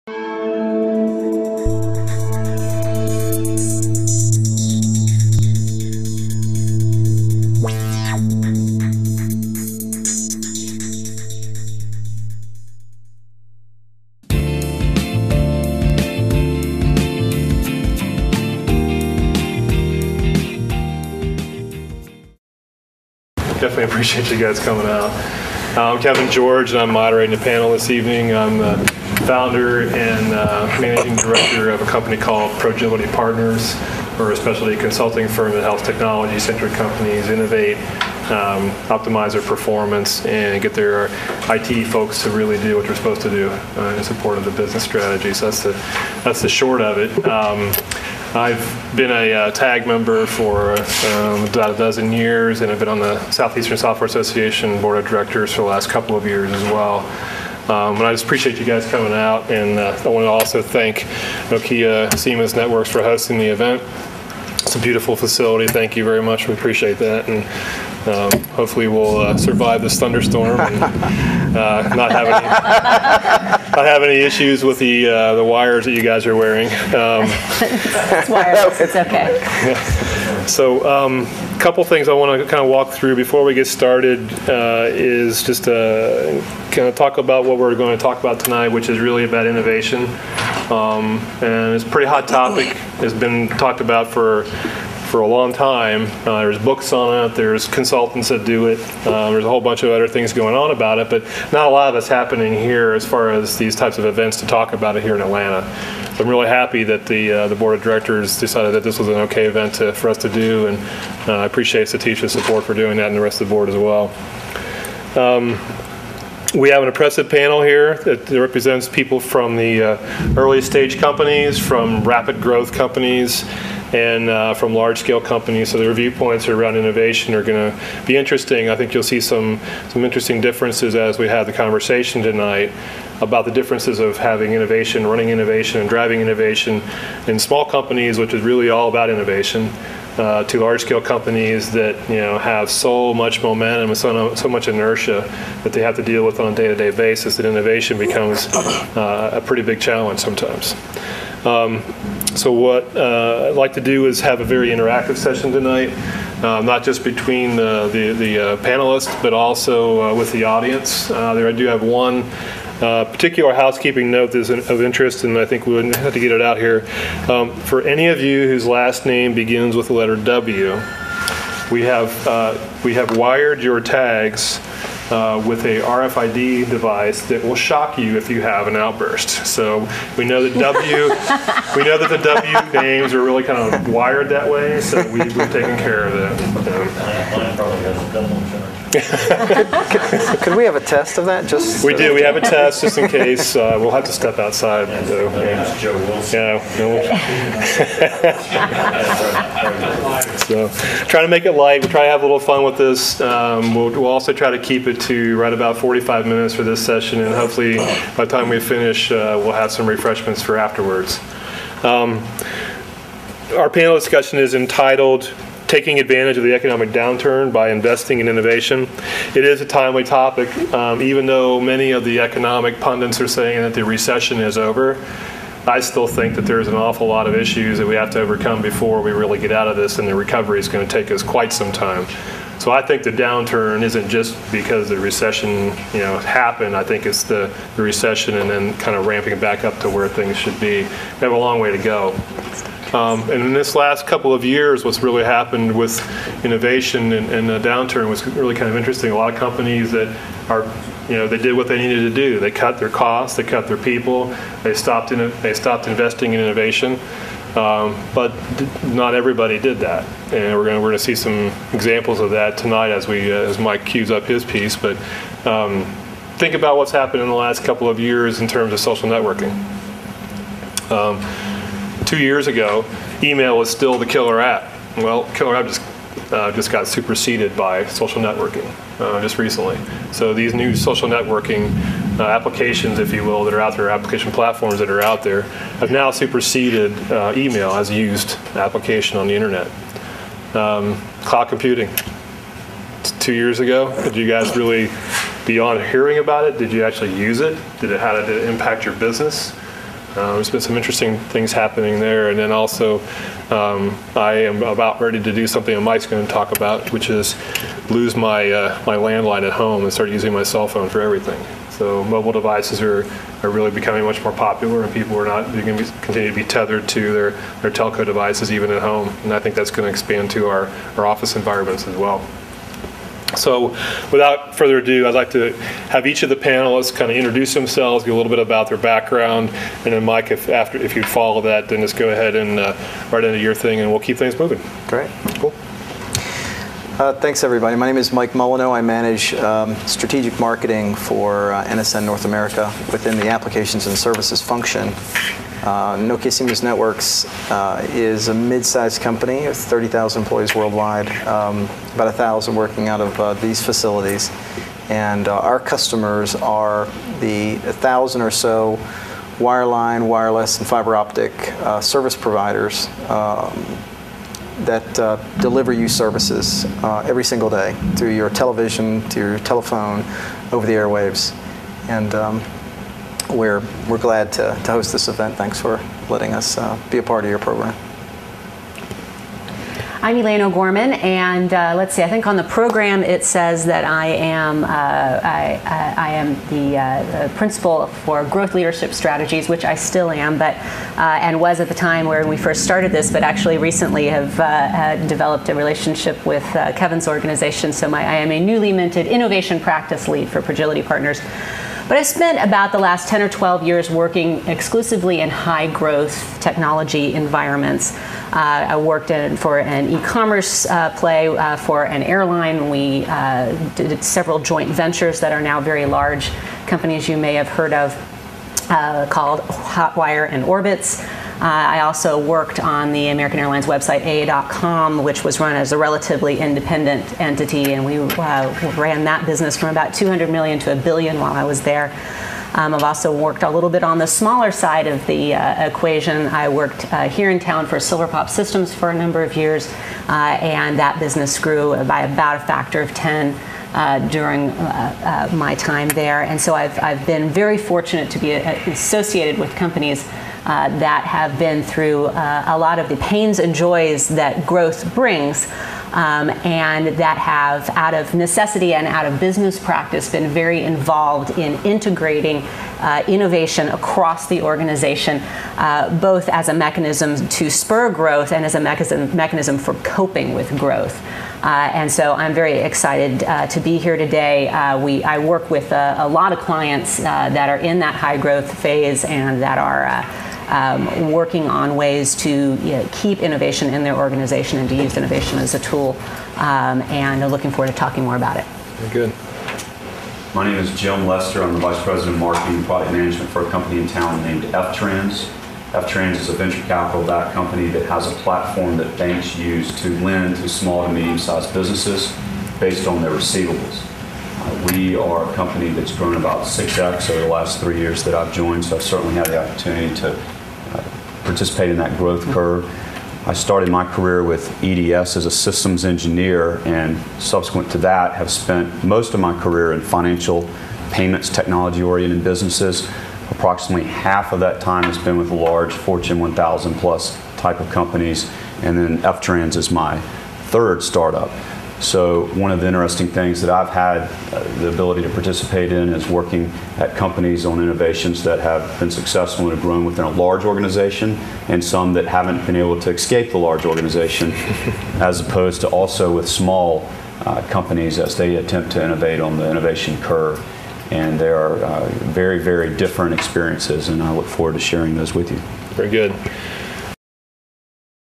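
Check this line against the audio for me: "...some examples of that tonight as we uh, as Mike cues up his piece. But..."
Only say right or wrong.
right.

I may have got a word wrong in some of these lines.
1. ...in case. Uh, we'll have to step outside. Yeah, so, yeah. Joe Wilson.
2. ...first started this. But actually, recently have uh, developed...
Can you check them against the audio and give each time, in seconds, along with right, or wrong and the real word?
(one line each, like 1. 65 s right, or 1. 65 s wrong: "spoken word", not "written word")
1. 192 s right
2. 392 s right.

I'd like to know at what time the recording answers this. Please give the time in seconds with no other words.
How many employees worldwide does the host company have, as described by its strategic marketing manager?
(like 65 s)
349 s.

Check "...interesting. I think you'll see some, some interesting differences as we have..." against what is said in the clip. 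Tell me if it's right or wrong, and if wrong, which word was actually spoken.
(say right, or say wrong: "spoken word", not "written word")
right.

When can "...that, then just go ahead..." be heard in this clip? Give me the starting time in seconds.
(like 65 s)
331 s.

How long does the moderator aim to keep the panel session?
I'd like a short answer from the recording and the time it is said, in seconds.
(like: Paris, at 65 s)
45 minutes, at 205 s.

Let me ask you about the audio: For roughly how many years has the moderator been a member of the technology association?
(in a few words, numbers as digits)
a dozen years.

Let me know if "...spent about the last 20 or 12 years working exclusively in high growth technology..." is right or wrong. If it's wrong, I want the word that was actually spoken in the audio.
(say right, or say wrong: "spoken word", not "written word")
wrong: "10", not "20".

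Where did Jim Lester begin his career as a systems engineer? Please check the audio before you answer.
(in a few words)
EDS.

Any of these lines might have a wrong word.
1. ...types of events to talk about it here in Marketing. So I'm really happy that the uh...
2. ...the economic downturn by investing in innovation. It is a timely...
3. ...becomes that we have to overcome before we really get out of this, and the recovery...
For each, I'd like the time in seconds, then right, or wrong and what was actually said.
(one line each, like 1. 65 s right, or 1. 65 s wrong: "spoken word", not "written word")
1. 103 s wrong: "Atlanta", not "Marketing"
2. 216 s right
3. 227 s wrong: "issues", not "becomes".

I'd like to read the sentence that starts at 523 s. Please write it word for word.
Approximately half of that time has been with large Fortune 1000 plus type of companies, and then FTrans is my third startup.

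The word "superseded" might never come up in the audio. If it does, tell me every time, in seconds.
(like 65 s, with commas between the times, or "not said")
276 s, 286 s.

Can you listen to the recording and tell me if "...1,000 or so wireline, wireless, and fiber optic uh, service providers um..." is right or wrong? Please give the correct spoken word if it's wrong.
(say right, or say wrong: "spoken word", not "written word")
right.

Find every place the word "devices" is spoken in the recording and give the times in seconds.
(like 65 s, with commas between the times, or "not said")
176 s, 312 s, 318 s.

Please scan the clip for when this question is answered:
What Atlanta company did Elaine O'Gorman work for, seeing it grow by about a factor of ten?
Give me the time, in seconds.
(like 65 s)
437 s.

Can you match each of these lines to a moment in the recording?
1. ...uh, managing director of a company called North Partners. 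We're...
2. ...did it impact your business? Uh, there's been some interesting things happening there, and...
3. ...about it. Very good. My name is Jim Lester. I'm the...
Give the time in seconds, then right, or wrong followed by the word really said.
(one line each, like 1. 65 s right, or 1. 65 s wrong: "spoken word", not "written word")
1. 30 s wrong: "Progility", not "North"
2. 298 s right
3. 488 s right.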